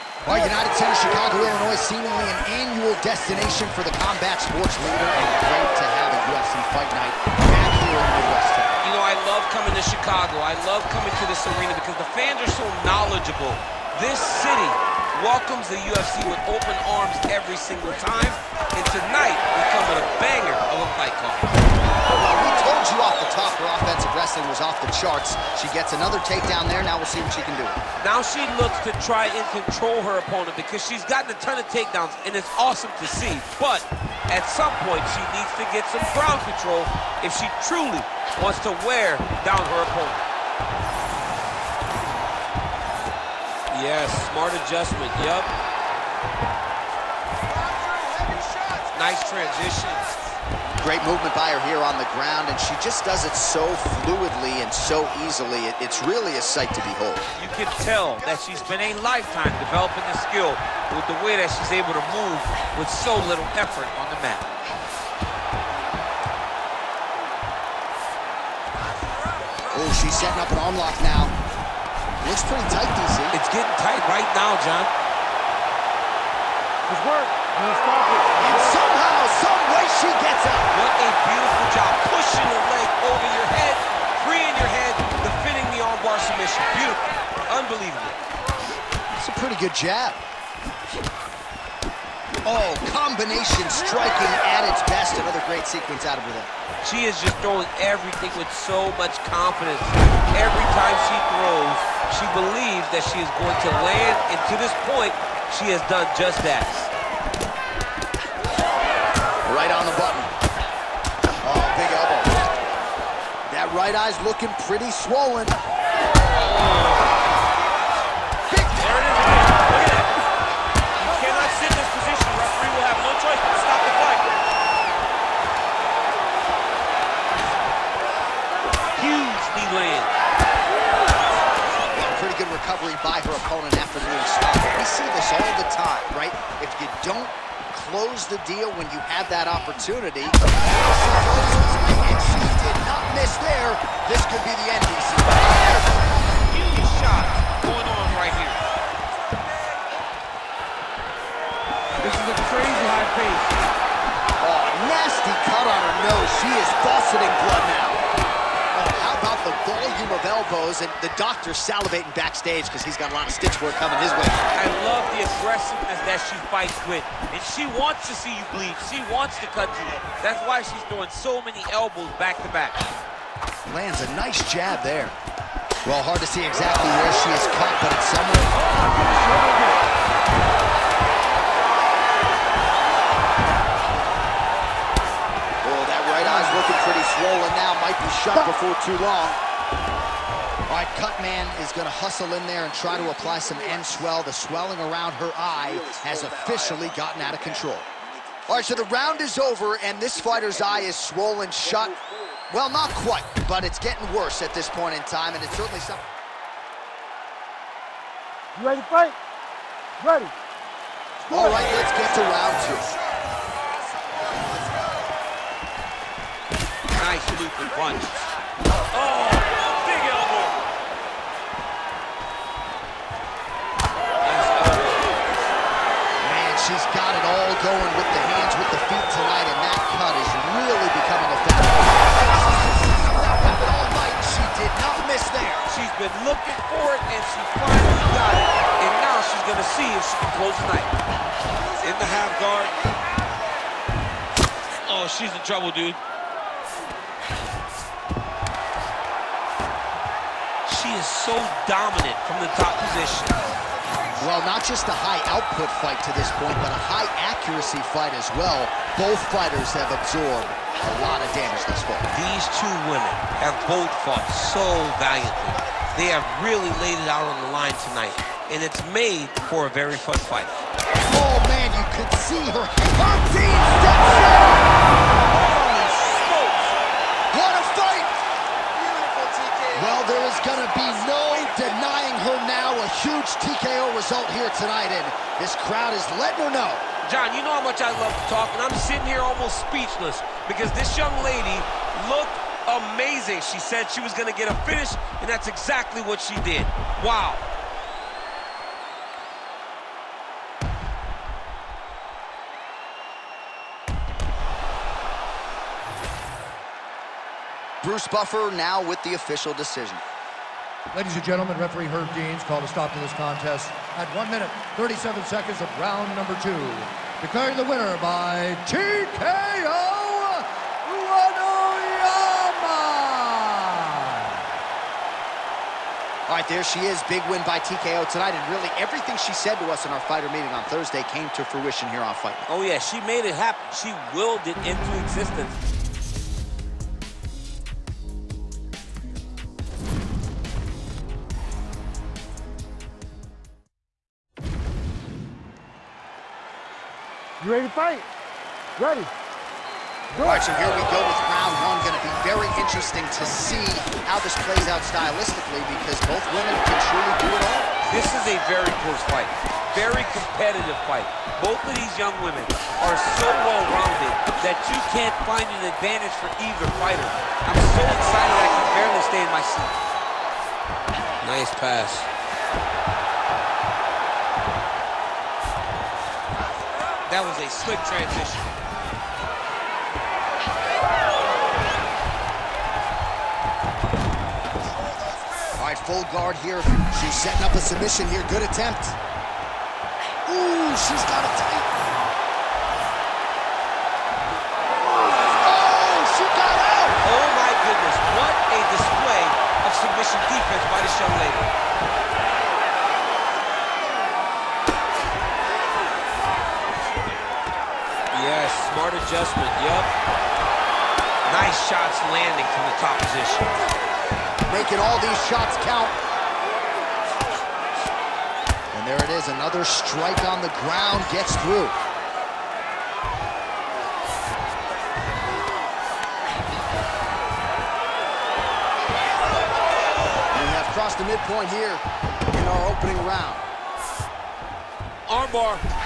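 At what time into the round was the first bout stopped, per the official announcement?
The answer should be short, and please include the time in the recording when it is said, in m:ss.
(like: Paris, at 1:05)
1 minute, 37 seconds, at 5:14.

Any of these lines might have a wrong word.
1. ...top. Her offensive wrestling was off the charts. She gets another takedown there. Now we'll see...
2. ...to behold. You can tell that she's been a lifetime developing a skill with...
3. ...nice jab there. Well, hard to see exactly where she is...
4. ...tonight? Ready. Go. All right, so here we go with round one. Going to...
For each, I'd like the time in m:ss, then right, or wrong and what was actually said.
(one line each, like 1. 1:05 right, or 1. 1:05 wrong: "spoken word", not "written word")
1. 0:23 right
2. 0:56 right
3. 2:54 right
4. 5:47 wrong: "fight", not "tonight".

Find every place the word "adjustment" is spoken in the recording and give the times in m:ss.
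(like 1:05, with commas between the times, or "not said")
0:44, 6:48.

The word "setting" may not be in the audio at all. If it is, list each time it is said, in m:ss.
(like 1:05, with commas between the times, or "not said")
1:10, 6:27.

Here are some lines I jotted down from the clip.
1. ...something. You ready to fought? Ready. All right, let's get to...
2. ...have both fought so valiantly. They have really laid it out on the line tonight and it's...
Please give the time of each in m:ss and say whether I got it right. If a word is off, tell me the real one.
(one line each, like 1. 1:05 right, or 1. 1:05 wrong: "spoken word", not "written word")
1. 3:25 wrong: "fight", not "fought"
2. 4:23 right.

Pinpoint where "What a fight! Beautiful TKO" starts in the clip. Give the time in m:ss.
4:37.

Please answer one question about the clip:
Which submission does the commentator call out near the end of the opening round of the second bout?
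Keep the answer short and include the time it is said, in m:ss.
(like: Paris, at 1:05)
Armbar, at 7:15.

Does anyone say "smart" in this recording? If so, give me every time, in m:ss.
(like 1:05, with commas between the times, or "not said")
0:44, 6:48.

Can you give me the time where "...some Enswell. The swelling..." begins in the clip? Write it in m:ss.
3:13.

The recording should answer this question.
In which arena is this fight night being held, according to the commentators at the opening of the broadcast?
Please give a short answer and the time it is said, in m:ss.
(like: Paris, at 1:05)
United Center, at 0:00.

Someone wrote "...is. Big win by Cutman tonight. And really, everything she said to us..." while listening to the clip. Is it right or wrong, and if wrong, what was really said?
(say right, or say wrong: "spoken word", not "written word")
wrong: "TKO", not "Cutman".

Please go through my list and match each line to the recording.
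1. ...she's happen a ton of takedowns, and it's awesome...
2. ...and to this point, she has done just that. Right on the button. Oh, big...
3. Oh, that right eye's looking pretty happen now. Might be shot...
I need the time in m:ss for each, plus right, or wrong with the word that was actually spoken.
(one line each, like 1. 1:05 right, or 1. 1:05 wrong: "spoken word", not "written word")
1. 0:30 wrong: "gotten", not "happen"
2. 1:44 right
3. 3:05 wrong: "swollen", not "happen".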